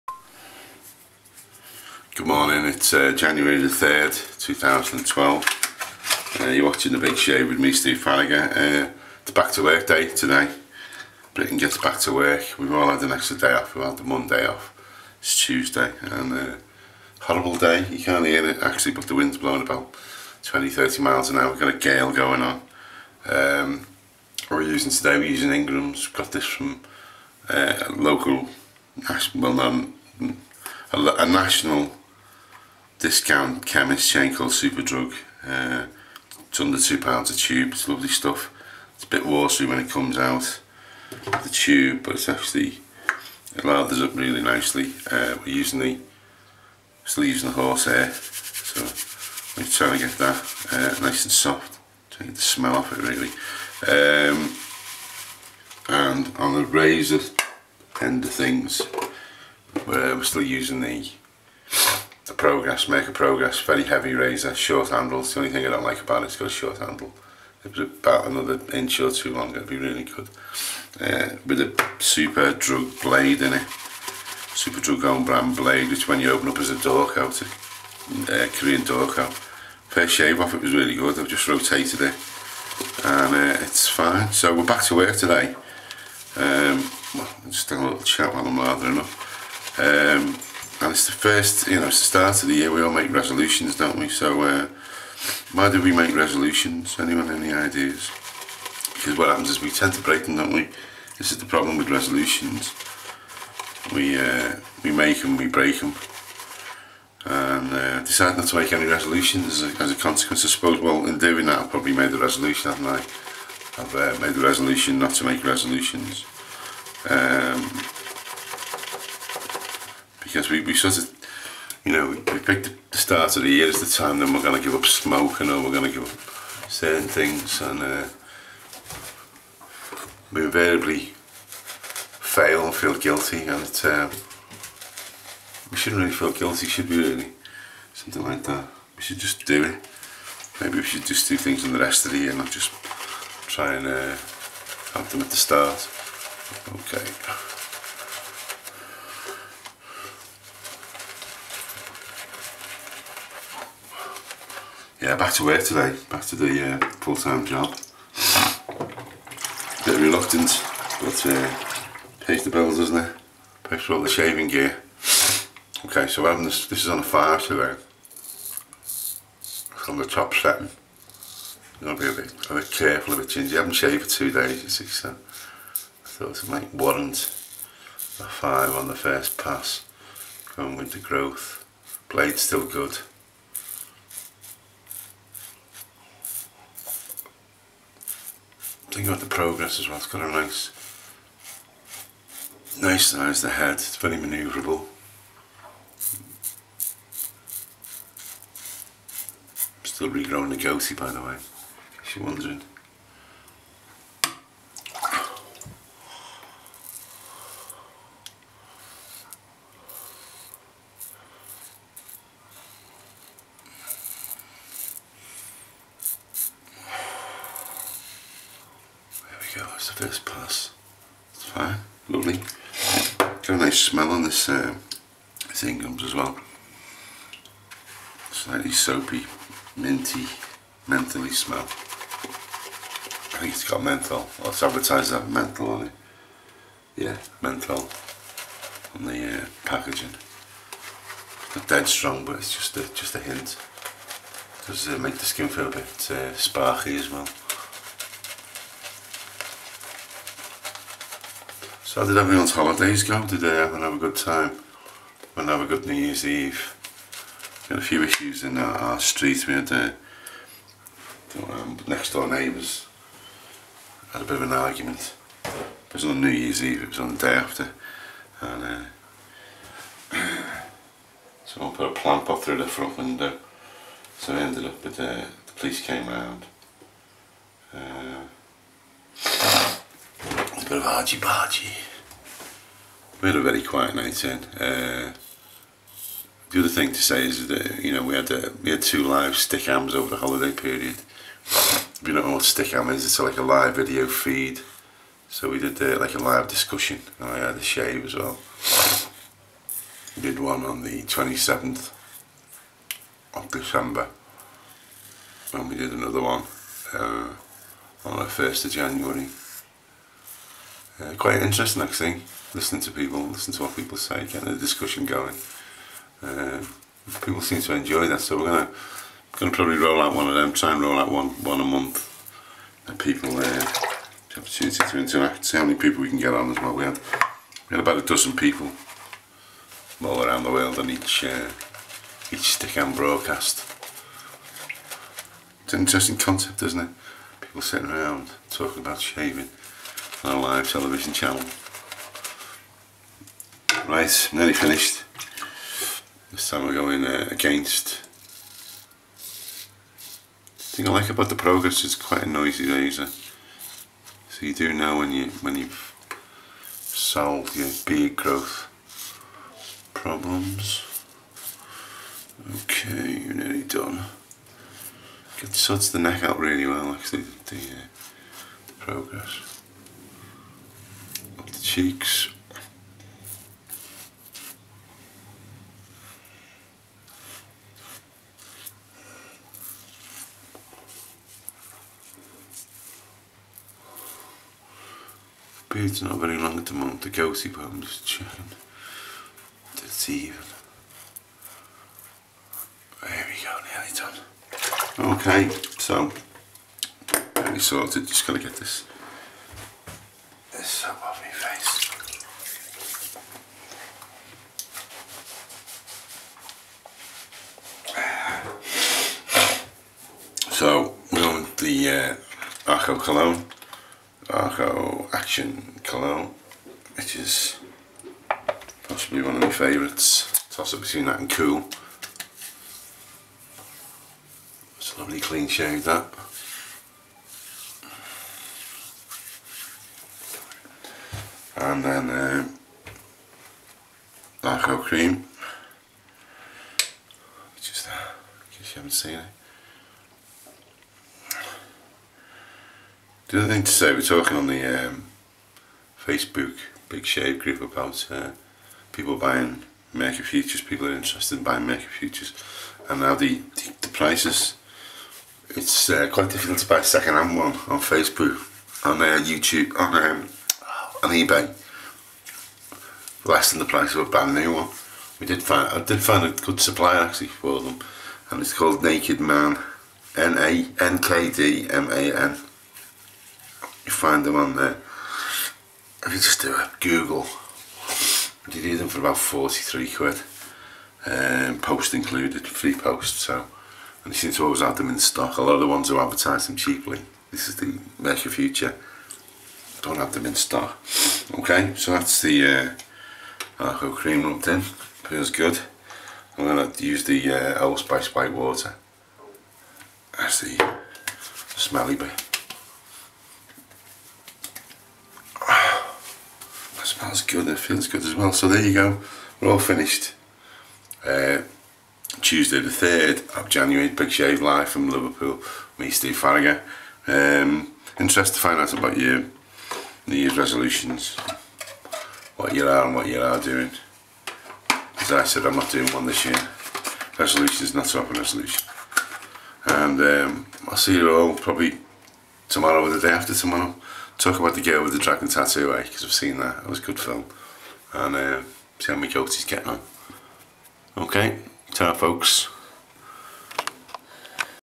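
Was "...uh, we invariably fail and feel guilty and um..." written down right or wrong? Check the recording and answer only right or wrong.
right.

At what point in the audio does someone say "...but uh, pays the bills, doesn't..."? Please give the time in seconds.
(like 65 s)
161 s.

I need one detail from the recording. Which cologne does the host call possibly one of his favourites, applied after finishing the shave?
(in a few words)
Arko Action Cologne.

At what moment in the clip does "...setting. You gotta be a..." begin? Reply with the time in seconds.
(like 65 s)
170 s.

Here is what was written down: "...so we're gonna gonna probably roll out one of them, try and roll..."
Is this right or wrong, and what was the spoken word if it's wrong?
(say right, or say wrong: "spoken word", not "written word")
right.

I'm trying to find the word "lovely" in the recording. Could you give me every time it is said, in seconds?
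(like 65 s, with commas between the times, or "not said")
37 s, 222 s, 424 s.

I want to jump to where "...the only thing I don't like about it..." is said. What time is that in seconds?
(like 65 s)
65 s.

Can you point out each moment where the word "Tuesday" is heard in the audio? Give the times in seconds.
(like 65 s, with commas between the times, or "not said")
15 s, 512 s.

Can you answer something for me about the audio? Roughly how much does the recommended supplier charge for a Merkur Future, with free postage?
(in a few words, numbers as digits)
£43.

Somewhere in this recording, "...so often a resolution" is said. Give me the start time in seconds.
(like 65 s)
527 s.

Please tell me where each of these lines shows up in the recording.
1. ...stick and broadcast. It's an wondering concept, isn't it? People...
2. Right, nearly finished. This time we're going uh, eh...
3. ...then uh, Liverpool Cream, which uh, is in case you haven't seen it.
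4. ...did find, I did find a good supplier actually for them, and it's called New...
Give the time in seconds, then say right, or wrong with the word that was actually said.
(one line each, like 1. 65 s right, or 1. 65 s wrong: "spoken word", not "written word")
1. 332 s wrong: "interesting", not "wondering"
2. 343 s right
3. 431 s wrong: "Arko", not "Liverpool"
4. 465 s wrong: "Naked", not "New".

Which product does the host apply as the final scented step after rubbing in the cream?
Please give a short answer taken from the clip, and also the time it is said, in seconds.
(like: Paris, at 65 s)
Old Spice White Water, at 497 s.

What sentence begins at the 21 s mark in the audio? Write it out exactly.
We've got a gale going on.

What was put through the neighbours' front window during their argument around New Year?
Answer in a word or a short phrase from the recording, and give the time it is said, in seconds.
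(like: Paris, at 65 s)
A plant pot, at 271 s.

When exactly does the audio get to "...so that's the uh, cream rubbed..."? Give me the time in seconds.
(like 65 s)
491 s.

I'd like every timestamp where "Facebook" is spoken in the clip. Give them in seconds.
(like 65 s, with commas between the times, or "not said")
445 s, 457 s.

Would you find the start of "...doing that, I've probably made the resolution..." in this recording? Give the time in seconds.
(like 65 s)
111 s.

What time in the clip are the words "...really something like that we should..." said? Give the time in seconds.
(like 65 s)
136 s.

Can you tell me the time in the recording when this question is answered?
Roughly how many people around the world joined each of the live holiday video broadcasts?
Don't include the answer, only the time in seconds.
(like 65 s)
327 s.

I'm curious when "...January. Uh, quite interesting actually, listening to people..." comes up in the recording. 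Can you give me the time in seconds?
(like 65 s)
308 s.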